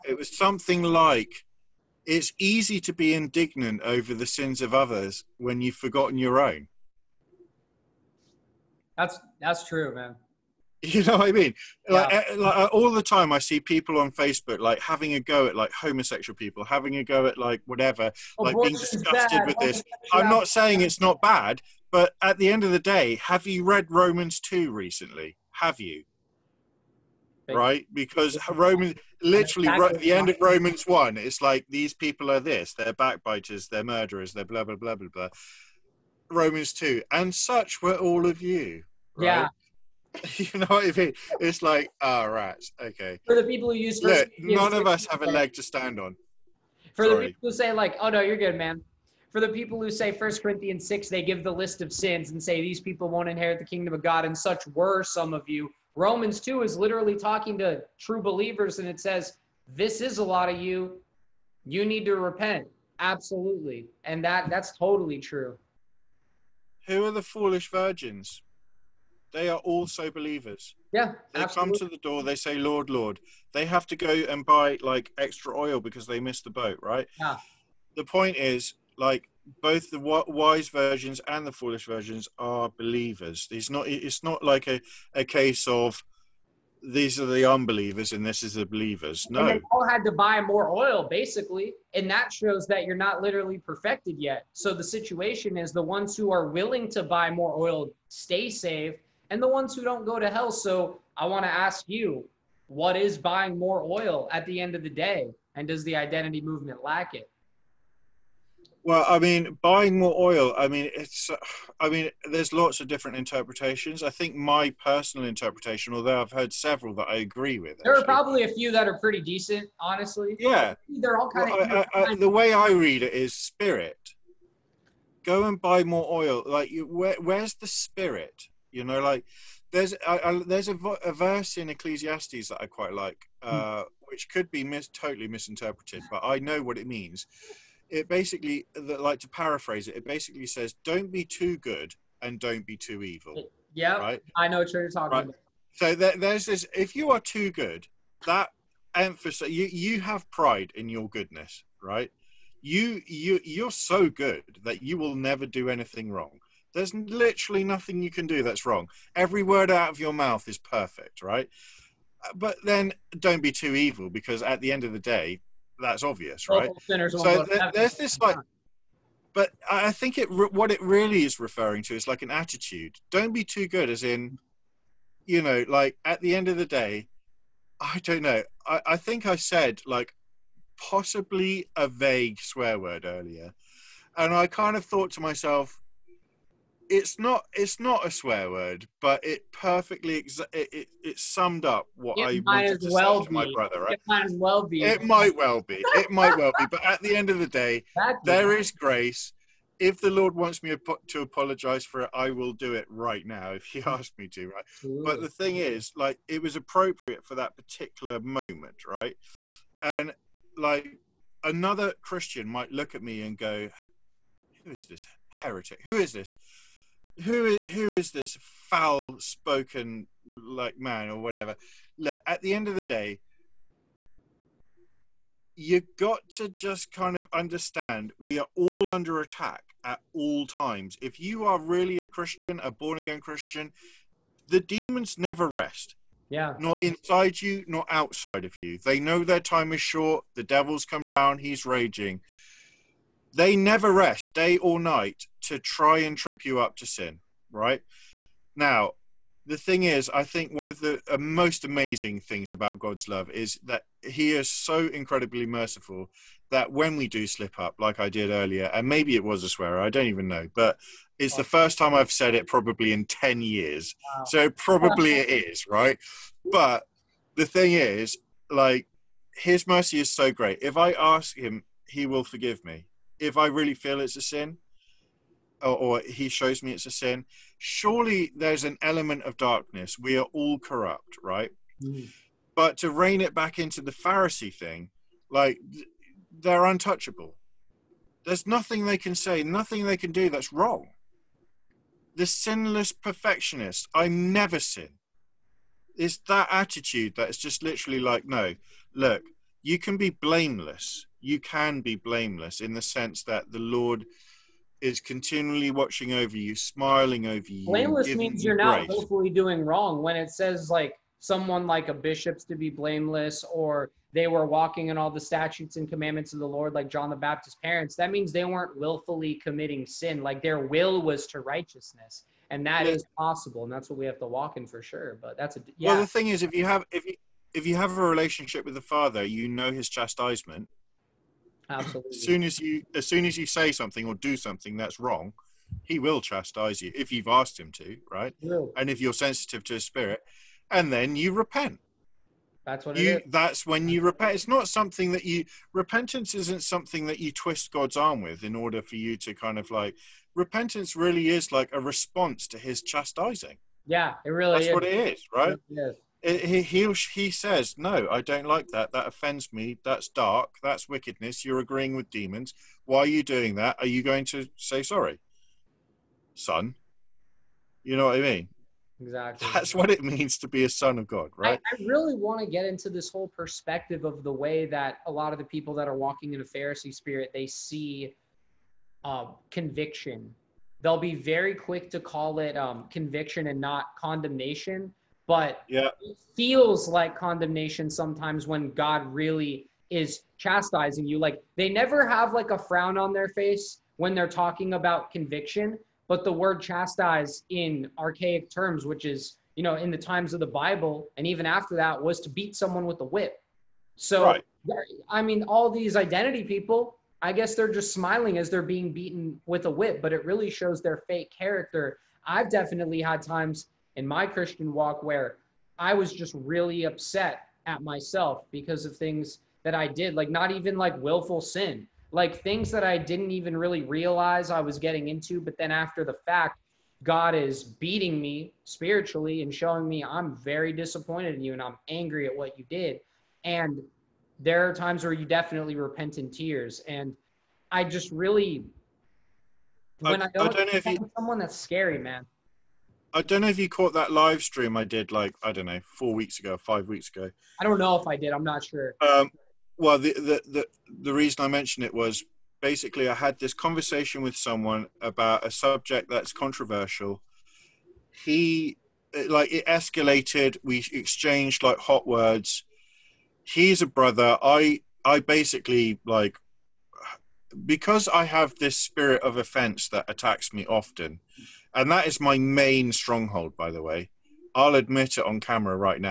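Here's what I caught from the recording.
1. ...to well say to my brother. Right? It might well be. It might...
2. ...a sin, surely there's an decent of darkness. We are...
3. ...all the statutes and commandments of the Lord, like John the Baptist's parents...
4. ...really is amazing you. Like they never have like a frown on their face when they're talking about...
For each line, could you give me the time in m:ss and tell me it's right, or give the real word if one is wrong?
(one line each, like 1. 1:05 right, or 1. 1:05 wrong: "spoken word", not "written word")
1. 3:12 right
2. 4:36 wrong: "element", not "decent"
3. 5:14 right
4. 6:29 wrong: "chastising", not "amazing".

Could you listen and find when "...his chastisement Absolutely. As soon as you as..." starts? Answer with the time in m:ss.
5:29.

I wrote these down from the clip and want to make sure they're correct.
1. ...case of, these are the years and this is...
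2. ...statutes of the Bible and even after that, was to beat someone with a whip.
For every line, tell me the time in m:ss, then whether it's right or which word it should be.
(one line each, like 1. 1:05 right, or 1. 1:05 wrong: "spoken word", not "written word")
1. 1:25 wrong: "unbelievers", not "years"
2. 6:39 wrong: "times", not "statutes".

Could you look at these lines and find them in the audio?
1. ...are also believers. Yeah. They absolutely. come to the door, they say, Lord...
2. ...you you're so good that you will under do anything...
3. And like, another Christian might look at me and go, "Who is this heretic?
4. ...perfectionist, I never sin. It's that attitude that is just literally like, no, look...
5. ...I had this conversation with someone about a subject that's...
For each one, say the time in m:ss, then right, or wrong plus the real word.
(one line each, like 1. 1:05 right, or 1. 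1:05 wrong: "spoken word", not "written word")
1. 1:09 right
2. 2:33 wrong: "never", not "under"
3. 3:29 right
4. 4:52 right
5. 7:33 right.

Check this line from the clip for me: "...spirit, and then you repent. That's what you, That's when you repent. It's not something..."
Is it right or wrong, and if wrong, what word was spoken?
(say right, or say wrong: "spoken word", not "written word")
right.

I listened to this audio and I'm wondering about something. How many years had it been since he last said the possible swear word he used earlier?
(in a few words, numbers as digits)
10 years.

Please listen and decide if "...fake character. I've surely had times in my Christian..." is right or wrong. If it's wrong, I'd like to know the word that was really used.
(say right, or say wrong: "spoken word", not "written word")
wrong: "definitely", not "surely".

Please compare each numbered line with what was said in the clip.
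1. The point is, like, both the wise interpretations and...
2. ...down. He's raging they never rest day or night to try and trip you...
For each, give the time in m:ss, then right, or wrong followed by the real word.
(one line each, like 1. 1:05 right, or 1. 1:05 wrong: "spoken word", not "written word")
1. 1:17 wrong: "virgins", not "interpretations"
2. 4:01 right.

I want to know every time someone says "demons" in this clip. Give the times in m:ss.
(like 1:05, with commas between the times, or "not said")
3:54, 6:02.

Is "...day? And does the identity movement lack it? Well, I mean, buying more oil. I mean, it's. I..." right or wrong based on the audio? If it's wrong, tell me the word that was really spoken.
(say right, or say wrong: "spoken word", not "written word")
right.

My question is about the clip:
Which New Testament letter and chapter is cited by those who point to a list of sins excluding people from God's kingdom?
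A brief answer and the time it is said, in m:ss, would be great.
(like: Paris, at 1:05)
First Corinthians 6, at 0:50.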